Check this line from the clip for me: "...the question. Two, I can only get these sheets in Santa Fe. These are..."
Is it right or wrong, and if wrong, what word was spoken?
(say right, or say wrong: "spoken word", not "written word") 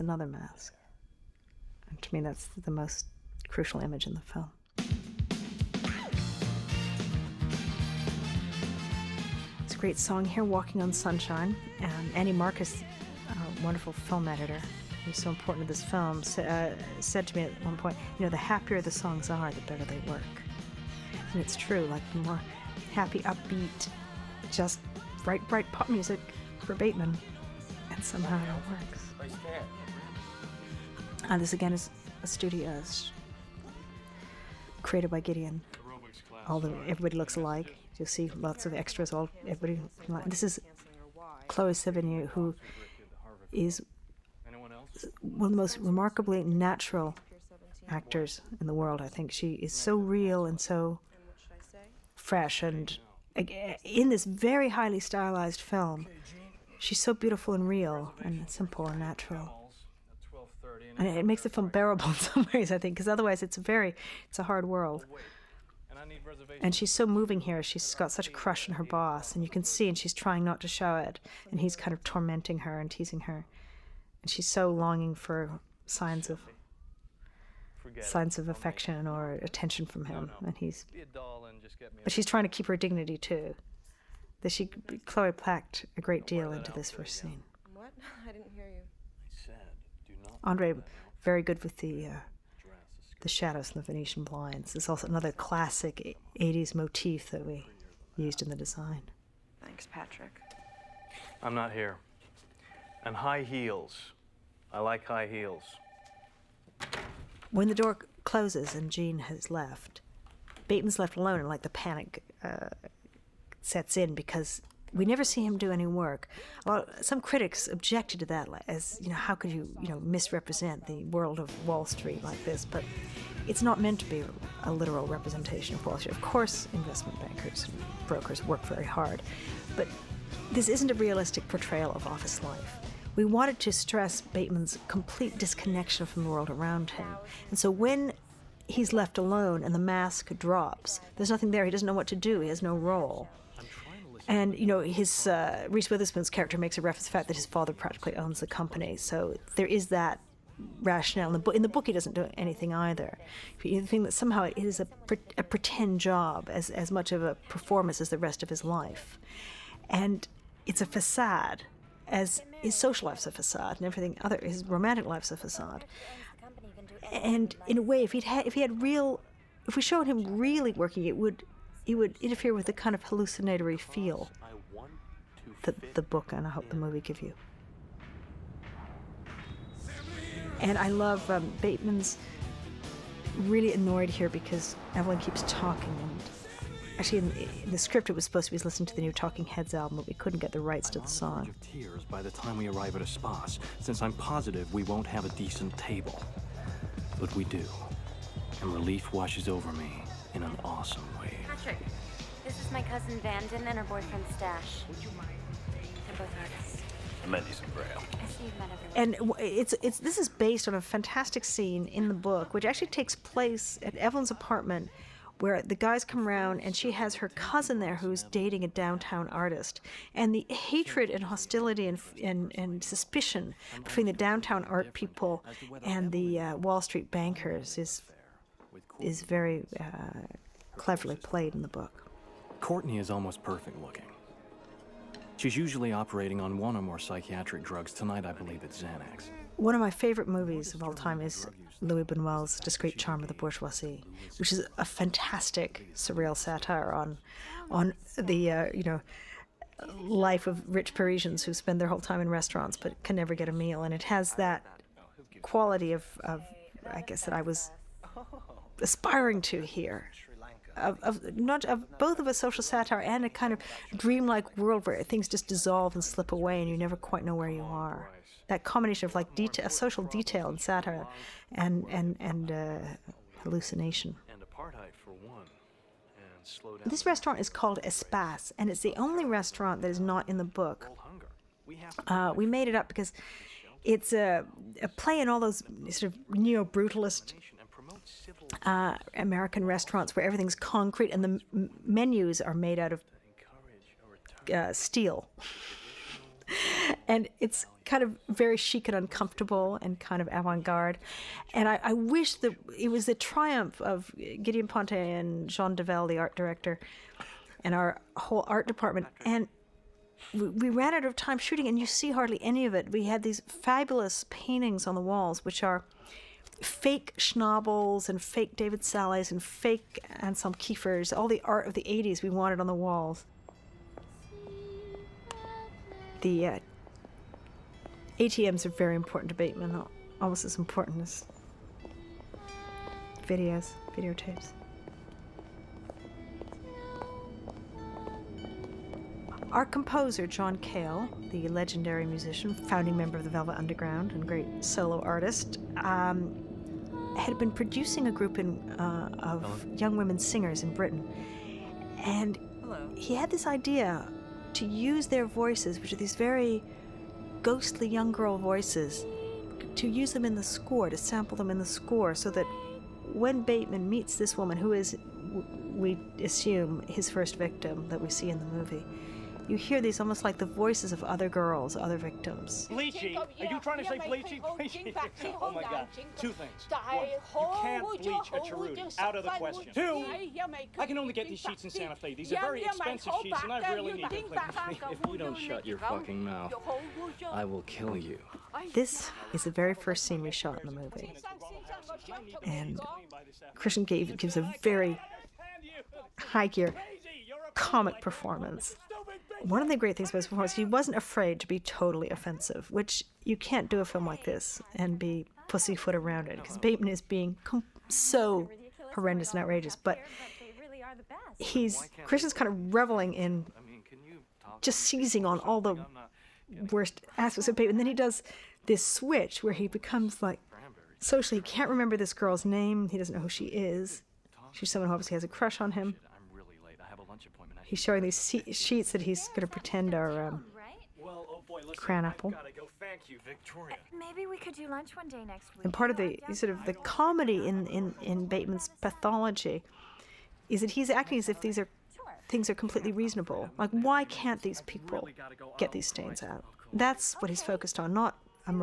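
right.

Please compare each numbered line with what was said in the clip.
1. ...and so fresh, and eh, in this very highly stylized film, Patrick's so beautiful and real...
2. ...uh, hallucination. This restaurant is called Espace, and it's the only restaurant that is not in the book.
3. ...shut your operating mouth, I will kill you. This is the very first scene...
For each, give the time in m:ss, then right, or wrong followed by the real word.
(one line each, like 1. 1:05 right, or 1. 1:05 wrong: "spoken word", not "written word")
1. 0:50 wrong: "She", not "Patrick"
2. 4:32 right
3. 6:25 wrong: "fucking", not "operating".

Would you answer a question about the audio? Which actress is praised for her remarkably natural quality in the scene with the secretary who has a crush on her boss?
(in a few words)
Chloe Sevigny.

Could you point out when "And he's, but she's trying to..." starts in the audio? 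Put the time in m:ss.
1:20.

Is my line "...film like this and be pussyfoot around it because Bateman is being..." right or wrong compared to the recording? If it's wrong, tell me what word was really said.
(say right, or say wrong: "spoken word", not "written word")
right.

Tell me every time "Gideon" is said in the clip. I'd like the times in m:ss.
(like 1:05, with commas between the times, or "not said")
0:35, 5:04.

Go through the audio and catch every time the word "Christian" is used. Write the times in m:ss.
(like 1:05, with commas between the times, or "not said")
6:33, 6:52.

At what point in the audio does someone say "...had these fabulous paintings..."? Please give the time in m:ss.
5:13.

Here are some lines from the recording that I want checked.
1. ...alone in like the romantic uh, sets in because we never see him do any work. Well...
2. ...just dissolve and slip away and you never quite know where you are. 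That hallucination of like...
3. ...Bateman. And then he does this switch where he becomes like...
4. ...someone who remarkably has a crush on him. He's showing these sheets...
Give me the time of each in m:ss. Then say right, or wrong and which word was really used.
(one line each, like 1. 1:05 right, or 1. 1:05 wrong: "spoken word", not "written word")
1. 1:51 wrong: "panic", not "romantic"
2. 4:25 wrong: "combination", not "hallucination"
3. 6:57 right
4. 7:04 wrong: "obviously", not "remarkably".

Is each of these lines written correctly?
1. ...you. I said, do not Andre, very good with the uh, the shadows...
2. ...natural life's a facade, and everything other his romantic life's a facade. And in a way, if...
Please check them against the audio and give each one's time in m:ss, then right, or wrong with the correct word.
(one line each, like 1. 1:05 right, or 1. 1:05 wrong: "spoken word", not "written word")
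1. 1:28 right
2. 2:42 wrong: "social", not "natural".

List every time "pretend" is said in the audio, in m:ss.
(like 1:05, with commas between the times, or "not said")
2:35, 7:09.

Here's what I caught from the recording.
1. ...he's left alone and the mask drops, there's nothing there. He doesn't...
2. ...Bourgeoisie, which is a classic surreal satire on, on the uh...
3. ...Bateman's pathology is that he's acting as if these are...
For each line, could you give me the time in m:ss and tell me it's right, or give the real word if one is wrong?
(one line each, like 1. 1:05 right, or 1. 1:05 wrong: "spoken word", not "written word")
1. 2:18 right
2. 4:03 wrong: "fantastic", not "classic"
3. 7:18 right.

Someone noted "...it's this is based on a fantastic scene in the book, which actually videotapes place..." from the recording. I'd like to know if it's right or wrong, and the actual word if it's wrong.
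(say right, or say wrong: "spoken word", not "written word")
wrong: "takes", not "videotapes".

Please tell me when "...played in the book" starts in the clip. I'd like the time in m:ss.
3:51.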